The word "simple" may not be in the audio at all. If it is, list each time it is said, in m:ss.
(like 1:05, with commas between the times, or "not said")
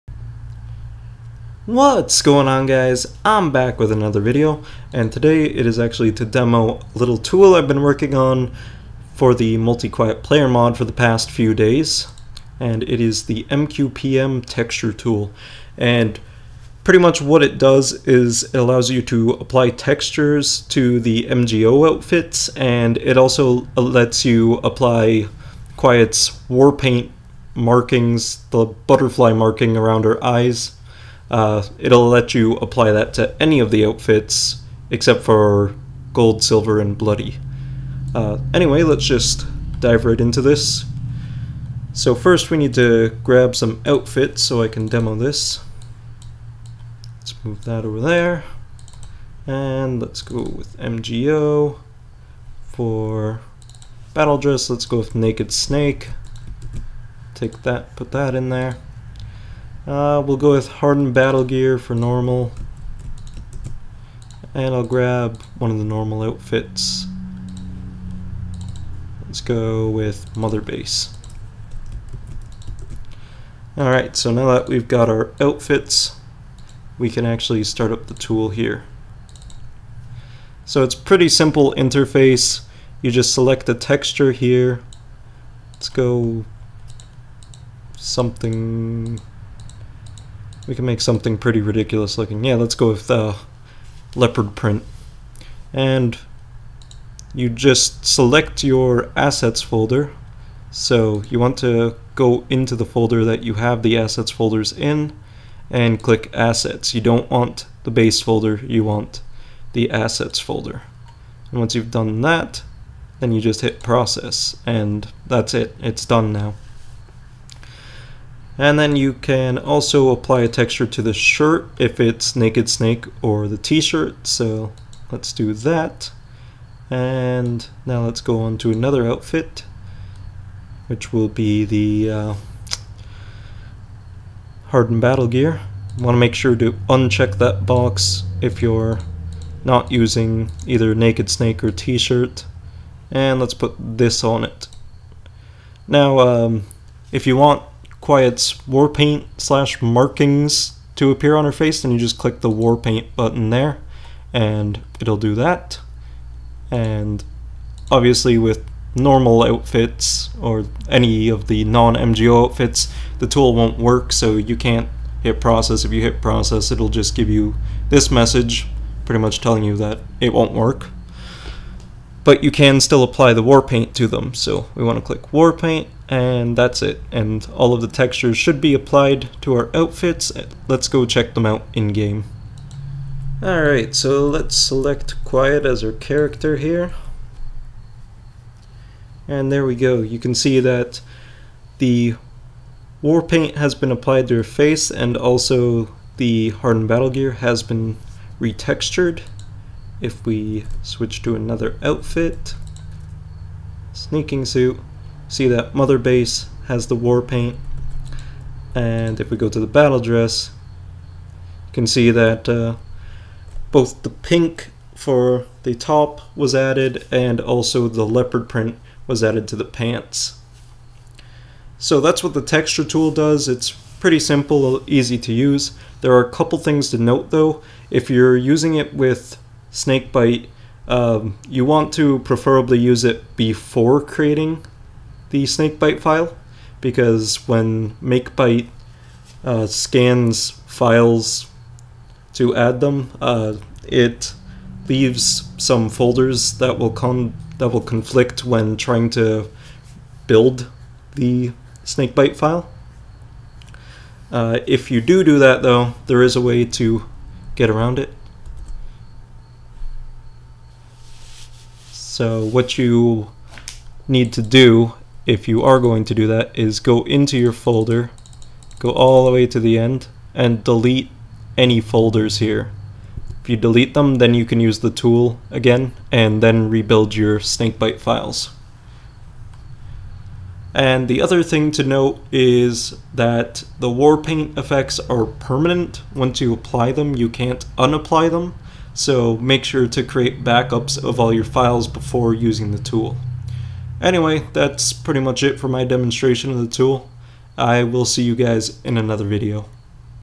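1:21, 3:44.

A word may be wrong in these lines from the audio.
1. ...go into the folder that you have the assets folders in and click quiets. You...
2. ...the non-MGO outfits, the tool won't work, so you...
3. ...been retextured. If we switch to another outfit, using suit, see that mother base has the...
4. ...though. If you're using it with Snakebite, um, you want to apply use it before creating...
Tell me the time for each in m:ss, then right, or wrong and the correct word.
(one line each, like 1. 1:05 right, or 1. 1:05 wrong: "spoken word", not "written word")
1. 1:42 wrong: "assets", not "quiets"
2. 2:41 right
3. 3:17 wrong: "sneaking", not "using"
4. 3:47 wrong: "preferably", not "apply".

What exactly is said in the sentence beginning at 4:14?
Uh, if you do do that though, there is a way to get around it.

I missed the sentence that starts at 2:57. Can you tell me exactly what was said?
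And all of the textures should be applied to our outfits.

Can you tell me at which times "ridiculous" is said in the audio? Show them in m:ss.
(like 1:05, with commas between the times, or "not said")
1:31.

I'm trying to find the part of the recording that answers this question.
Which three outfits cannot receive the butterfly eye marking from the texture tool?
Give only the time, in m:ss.
0:36.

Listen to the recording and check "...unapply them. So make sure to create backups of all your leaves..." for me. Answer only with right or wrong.
wrong.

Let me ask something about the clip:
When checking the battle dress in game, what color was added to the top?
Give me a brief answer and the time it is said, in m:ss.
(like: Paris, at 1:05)
pink, at 3:34.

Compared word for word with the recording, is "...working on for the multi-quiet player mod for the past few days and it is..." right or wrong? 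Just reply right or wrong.
right.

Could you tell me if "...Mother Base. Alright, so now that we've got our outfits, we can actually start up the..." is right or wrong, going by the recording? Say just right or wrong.
right.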